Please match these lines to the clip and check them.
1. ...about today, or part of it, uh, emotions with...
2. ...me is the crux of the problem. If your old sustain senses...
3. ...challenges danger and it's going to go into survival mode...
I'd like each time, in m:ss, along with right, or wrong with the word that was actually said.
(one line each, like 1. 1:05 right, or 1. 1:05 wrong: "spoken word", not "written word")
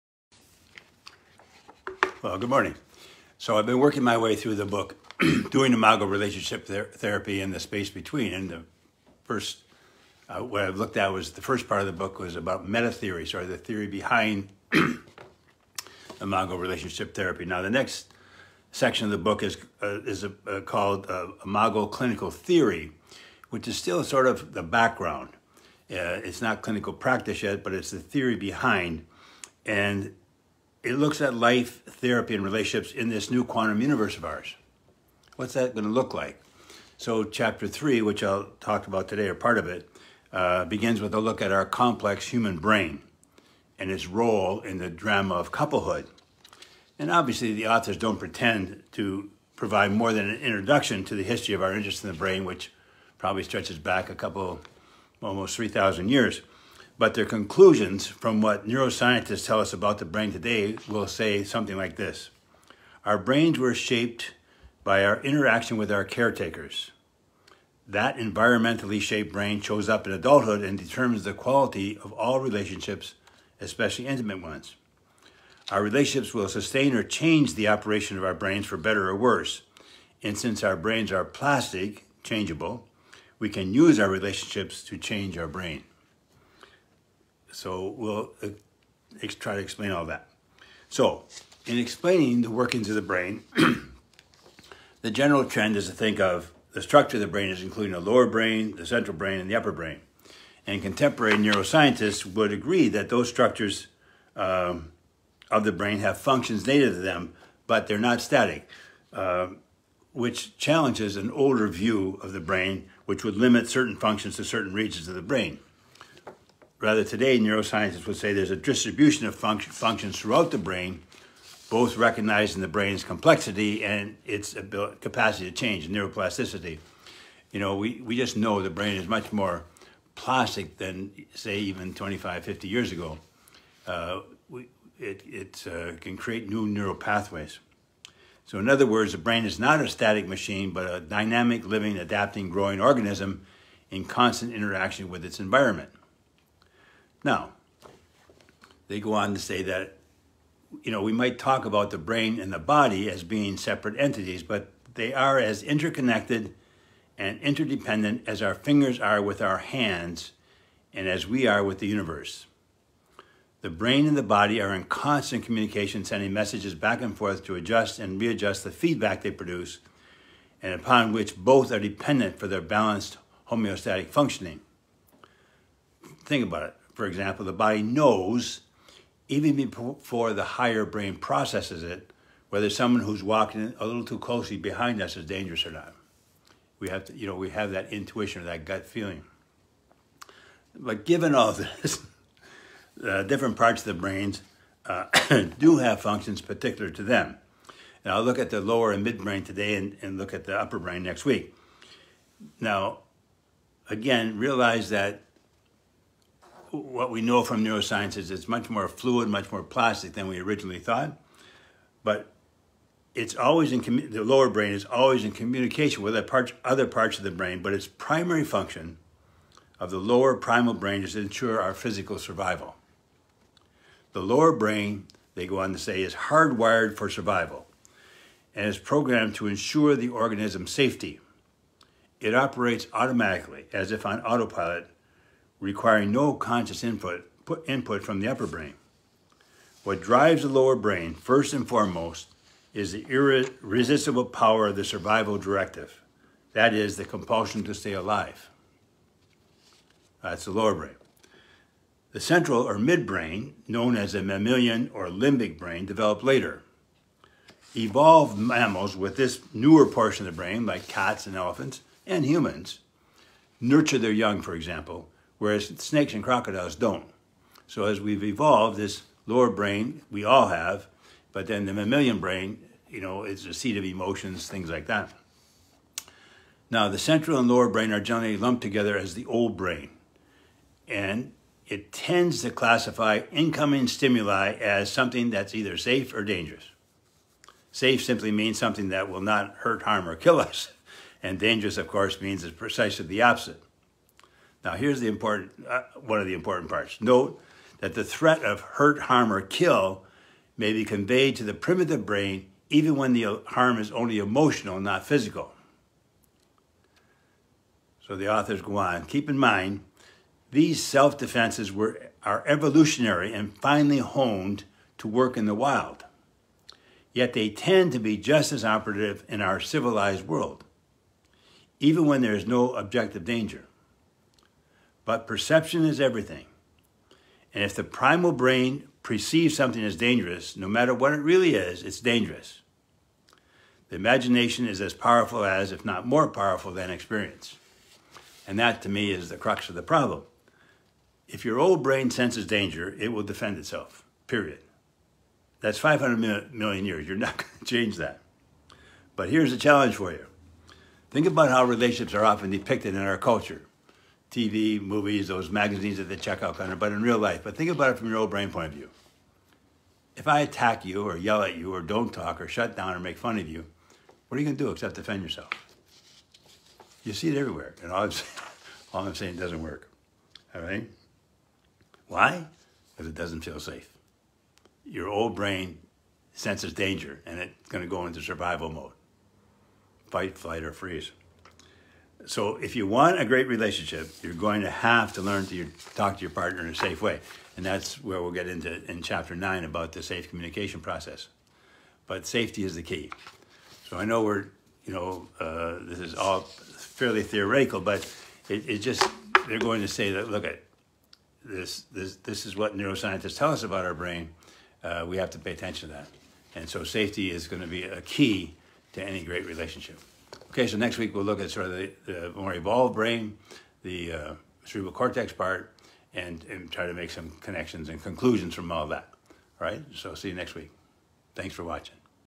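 1. 0:38 wrong: "begins", not "emotions"
2. 5:38 wrong: "brain", not "sustain"
3. 6:16 wrong: "senses", not "challenges".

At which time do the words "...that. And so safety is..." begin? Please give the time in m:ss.
6:45.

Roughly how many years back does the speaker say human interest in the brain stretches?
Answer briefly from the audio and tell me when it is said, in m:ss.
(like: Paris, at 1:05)
3,000, at 0:55.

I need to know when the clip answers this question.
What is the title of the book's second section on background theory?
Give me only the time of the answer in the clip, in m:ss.
0:21.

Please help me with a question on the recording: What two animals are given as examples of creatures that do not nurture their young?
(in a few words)
Snakes and crocodiles.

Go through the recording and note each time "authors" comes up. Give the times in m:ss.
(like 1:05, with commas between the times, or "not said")
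0:47, 5:08.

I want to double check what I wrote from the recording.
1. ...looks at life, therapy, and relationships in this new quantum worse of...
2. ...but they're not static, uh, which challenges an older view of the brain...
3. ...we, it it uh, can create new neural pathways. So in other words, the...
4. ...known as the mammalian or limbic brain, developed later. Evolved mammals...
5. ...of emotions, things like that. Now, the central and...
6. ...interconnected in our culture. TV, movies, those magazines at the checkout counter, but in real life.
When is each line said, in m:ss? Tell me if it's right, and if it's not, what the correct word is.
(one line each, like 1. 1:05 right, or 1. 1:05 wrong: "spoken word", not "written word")
1. 0:30 wrong: "universe", not "worse"
2. 1:47 right
3. 2:14 right
4. 4:13 right
5. 4:33 right
6. 5:52 wrong: "depicted", not "interconnected".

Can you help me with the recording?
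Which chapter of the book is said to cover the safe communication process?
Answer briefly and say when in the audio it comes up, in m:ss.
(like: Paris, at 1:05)
Chapter 9, at 6:29.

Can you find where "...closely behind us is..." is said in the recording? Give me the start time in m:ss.
3:04.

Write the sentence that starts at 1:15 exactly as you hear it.
Our relationships will sustain or change the operation of our brains for better or worse.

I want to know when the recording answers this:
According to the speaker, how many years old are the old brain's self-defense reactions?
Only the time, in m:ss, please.
5:45.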